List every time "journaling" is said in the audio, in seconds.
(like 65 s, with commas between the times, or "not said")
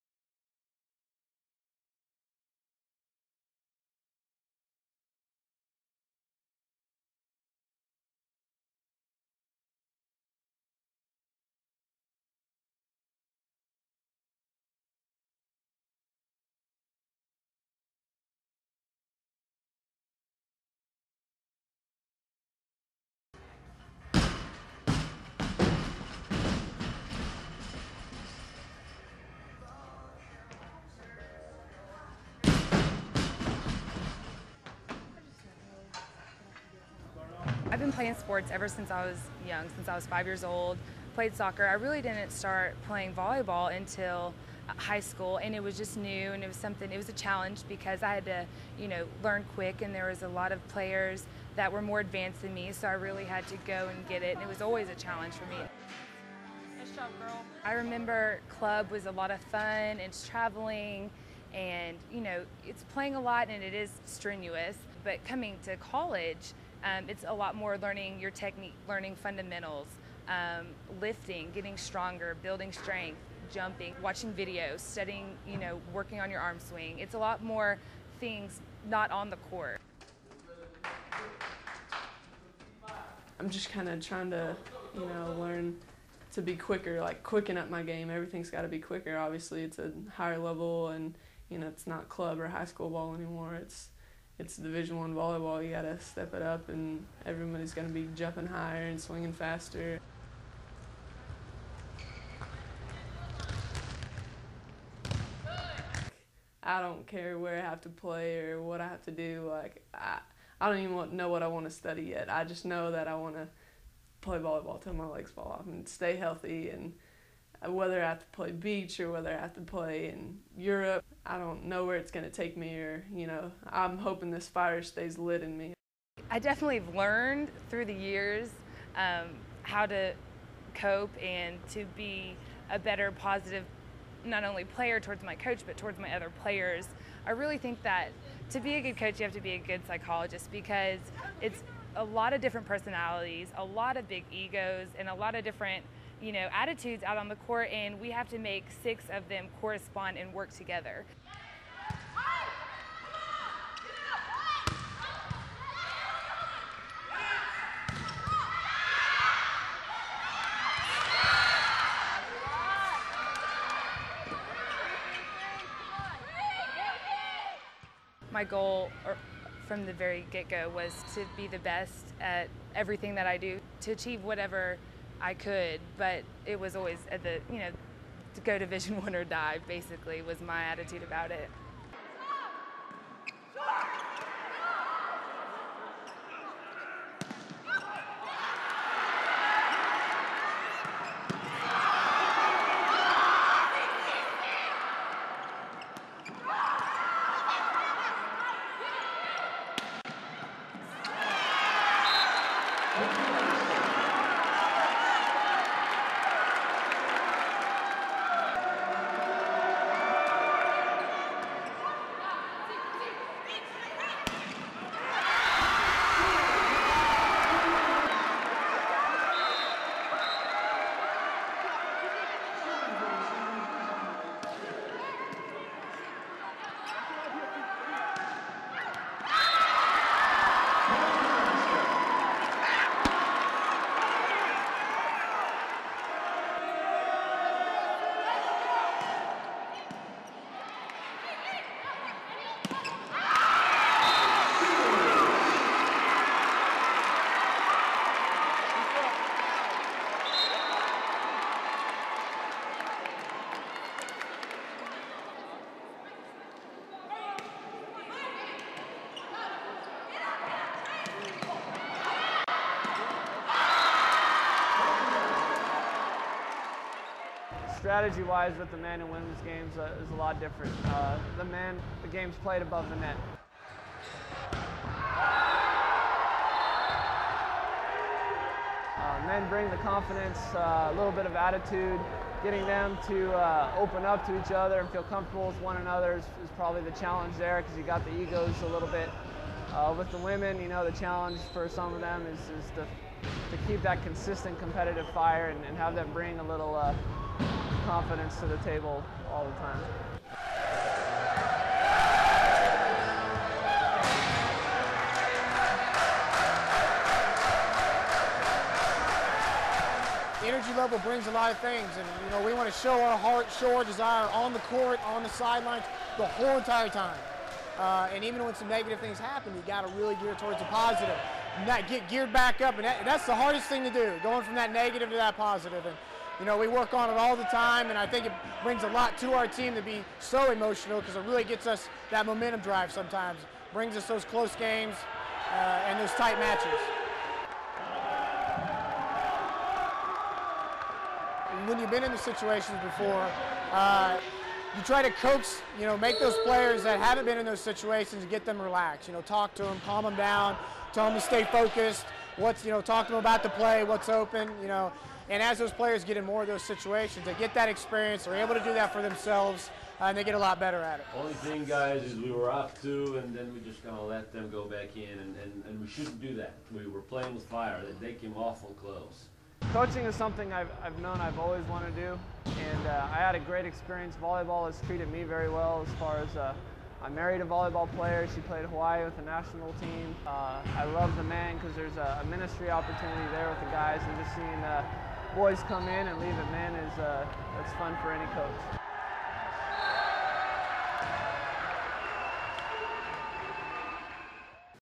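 not said.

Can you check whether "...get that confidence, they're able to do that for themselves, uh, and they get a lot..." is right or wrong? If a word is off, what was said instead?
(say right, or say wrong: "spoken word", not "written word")
wrong: "experience", not "confidence".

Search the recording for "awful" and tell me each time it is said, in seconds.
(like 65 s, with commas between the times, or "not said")
368 s.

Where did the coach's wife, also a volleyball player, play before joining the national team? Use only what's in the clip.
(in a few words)
Hawaii.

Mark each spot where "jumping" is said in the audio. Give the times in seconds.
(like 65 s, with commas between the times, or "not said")
73 s, 98 s.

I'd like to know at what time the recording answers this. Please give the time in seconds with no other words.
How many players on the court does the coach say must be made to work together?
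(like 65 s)
148 s.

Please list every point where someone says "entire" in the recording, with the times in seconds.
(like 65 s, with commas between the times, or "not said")
316 s.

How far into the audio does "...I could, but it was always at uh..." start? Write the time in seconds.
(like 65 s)
175 s.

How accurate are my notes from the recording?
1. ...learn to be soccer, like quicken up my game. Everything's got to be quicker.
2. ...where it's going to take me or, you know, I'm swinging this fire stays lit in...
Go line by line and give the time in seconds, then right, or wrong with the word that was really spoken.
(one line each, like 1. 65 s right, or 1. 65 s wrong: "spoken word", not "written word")
1. 85 s wrong: "quicker", not "soccer"
2. 121 s wrong: "hoping", not "swinging".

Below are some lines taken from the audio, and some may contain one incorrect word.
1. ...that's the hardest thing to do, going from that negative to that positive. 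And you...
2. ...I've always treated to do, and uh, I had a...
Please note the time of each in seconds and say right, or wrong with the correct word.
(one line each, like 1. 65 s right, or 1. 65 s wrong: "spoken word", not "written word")
1. 323 s right
2. 371 s wrong: "wanted", not "treated".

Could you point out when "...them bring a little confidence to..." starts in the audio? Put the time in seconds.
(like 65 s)
295 s.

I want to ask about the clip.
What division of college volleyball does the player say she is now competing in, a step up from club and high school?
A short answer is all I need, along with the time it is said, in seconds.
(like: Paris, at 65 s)
Division One, at 94 s.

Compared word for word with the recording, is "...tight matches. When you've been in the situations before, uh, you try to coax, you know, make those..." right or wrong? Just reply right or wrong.
right.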